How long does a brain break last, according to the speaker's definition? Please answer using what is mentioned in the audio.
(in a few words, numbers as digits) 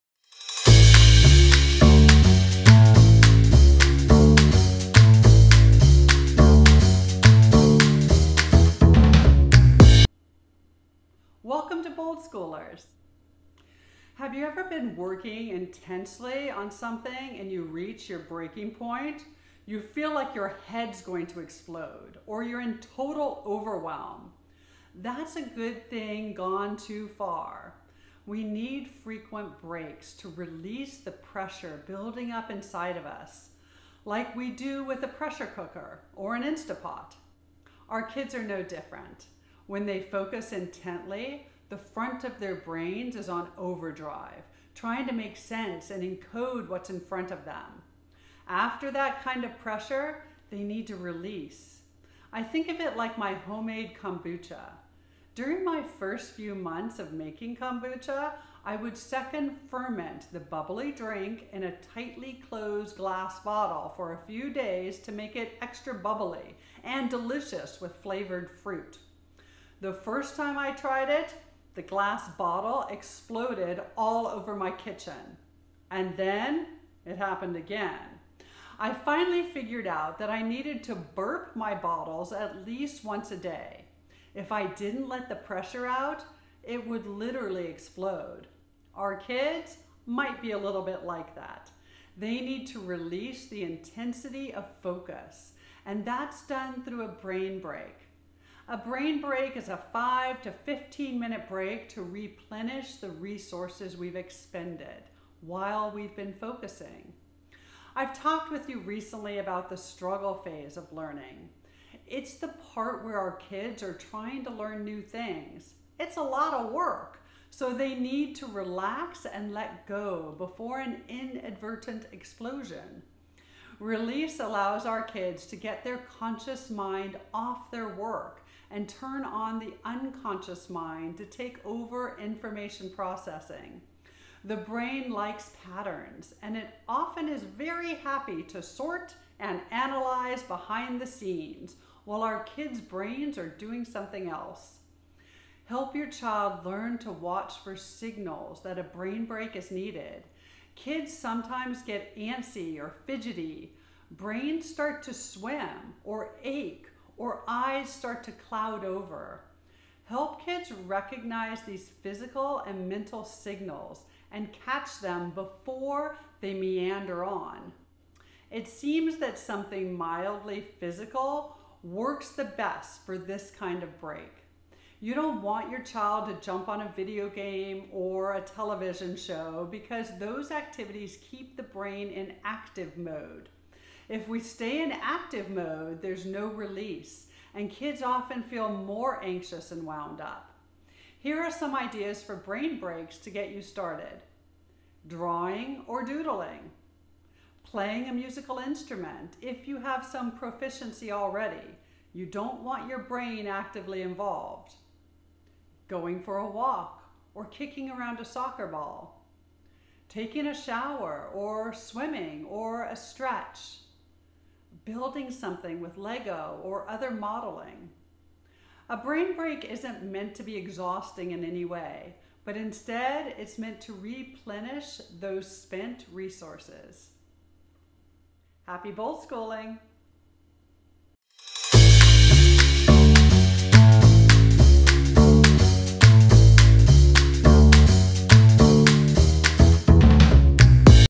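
5 to 15 minutes.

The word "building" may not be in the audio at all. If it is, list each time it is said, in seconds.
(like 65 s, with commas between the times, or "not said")
31 s, 214 s.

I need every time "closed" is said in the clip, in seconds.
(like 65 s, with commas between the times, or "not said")
62 s.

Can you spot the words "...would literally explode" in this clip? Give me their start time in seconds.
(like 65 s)
86 s.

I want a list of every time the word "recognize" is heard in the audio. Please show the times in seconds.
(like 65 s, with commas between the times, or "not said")
160 s.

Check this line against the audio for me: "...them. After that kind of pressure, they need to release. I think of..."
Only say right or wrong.
right.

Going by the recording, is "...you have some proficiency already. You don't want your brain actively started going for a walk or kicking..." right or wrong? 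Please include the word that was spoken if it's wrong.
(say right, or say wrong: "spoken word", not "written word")
wrong: "involved", not "started".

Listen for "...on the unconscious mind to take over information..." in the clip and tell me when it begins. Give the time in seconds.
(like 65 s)
129 s.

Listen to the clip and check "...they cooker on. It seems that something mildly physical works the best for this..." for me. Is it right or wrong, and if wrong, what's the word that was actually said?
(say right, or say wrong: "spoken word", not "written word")
wrong: "meander", not "cooker".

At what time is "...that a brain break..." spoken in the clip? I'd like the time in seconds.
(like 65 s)
148 s.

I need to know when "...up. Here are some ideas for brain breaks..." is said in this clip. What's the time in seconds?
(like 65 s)
190 s.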